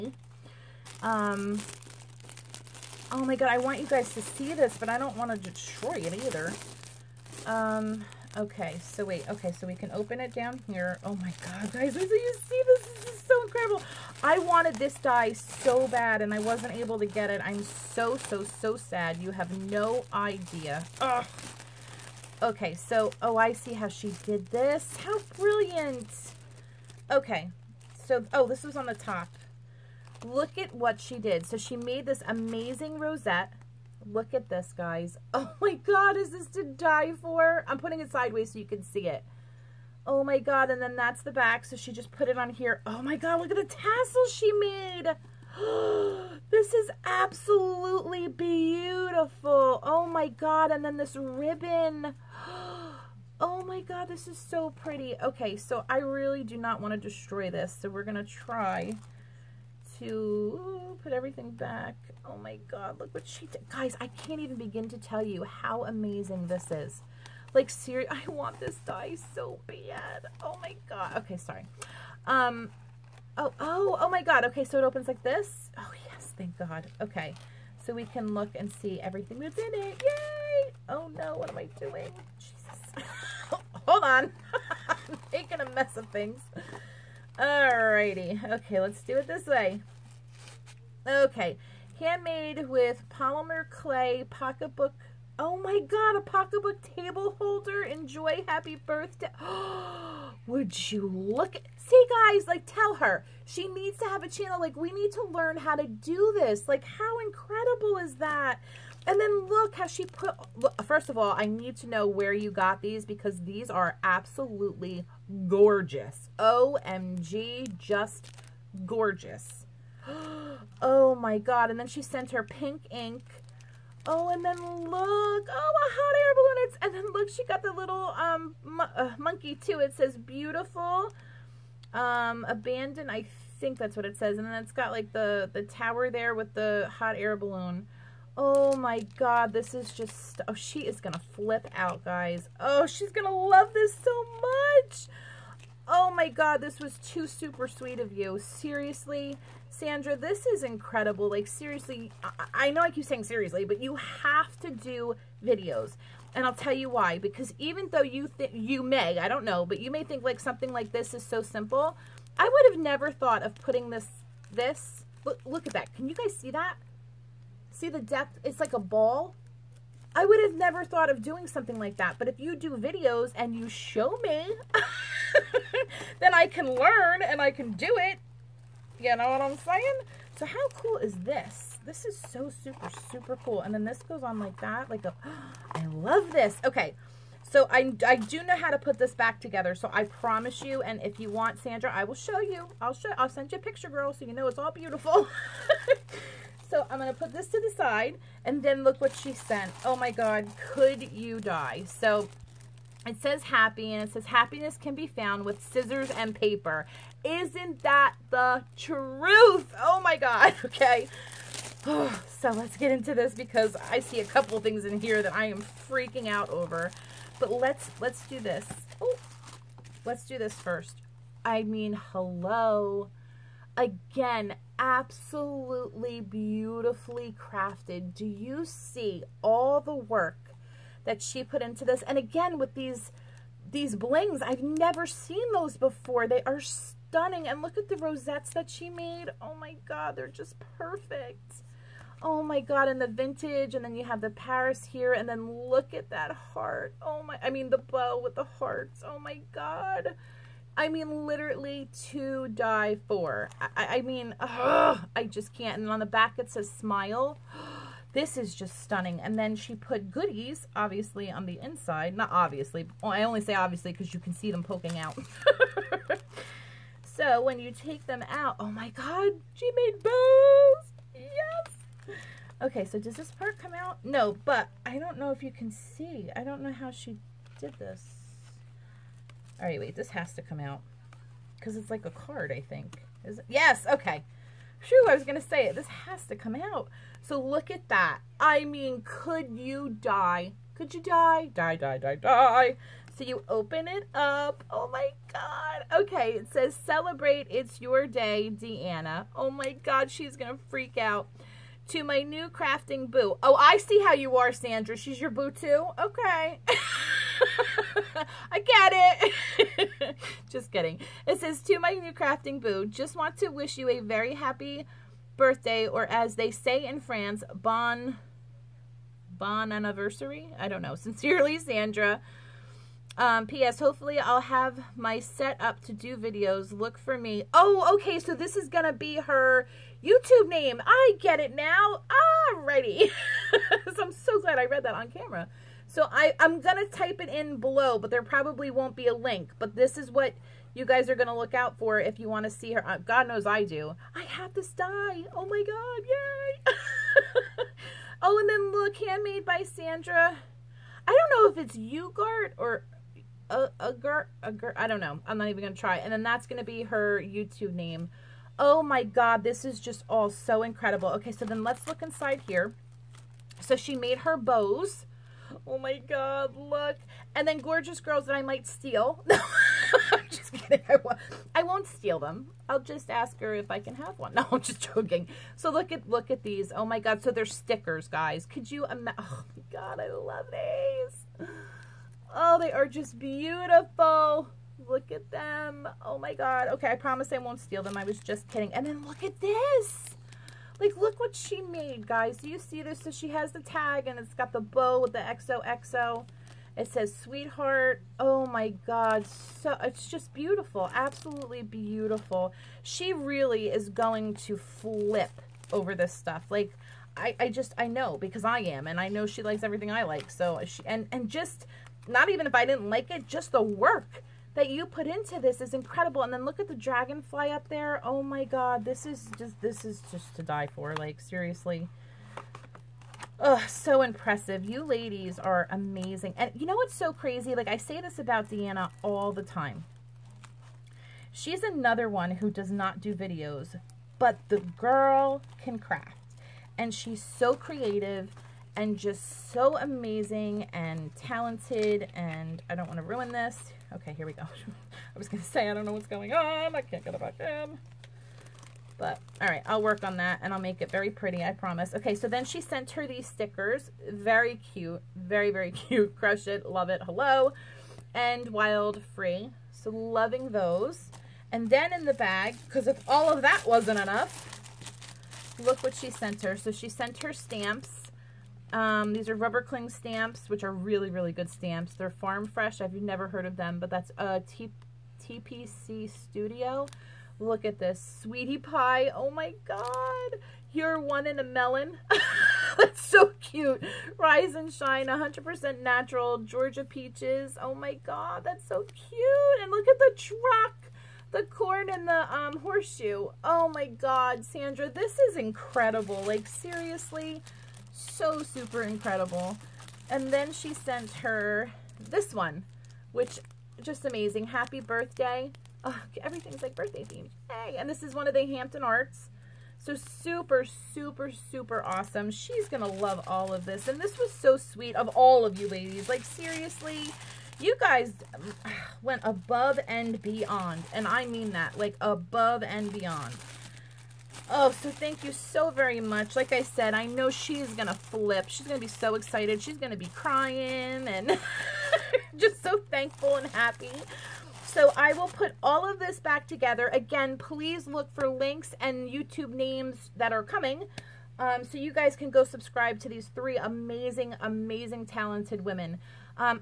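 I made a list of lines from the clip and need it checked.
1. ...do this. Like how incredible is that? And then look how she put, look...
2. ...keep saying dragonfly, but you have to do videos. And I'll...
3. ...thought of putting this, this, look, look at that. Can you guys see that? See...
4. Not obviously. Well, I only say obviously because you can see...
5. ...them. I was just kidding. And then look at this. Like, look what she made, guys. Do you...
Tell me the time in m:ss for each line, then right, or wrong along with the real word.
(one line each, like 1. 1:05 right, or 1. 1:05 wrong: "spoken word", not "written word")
1. 1:45 right
2. 2:32 wrong: "seriously", not "dragonfly"
3. 2:43 right
4. 4:22 right
5. 6:27 right.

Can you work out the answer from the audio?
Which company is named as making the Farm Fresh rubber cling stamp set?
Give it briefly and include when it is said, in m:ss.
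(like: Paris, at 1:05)
TPC Studio, at 7:55.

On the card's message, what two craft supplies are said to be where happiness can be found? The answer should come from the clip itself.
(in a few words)
Scissors and paper.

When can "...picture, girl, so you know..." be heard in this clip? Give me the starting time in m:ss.
3:13.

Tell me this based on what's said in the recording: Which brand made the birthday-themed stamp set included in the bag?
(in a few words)
Hampton Arts.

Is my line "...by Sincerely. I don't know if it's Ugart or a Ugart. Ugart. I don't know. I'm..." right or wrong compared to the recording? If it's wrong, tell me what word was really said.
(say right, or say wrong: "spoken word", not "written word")
wrong: "Sandra", not "Sincerely".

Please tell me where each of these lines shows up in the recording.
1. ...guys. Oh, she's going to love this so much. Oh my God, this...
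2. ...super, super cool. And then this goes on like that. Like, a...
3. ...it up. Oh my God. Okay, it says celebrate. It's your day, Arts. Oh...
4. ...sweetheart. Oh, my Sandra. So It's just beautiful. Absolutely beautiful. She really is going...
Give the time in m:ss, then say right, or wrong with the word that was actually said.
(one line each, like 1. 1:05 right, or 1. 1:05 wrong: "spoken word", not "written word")
1. 2:22 right
2. 3:02 right
3. 4:53 wrong: "Deanna", not "Arts"
4. 6:37 wrong: "God", not "Sandra".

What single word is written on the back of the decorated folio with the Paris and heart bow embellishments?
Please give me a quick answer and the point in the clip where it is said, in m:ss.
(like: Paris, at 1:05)
Smile, at 4:16.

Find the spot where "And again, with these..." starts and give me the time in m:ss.
3:52.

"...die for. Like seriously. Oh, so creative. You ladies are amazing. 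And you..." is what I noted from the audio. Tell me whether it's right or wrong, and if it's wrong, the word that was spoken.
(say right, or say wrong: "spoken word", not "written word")
wrong: "impressive", not "creative".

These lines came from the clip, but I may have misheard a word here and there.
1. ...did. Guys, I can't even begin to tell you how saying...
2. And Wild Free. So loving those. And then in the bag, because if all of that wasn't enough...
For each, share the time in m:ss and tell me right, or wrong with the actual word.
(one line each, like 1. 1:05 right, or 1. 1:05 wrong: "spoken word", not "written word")
1. 1:03 wrong: "amazing", not "saying"
2. 7:38 right.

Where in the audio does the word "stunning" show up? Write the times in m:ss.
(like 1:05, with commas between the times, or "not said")
3:56, 4:18.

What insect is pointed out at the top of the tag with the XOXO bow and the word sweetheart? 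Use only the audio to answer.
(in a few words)
Dragonfly.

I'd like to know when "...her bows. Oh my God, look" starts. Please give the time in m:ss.
6:04.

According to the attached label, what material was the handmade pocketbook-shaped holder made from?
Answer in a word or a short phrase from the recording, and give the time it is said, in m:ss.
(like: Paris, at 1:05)
Polymer clay, at 1:33.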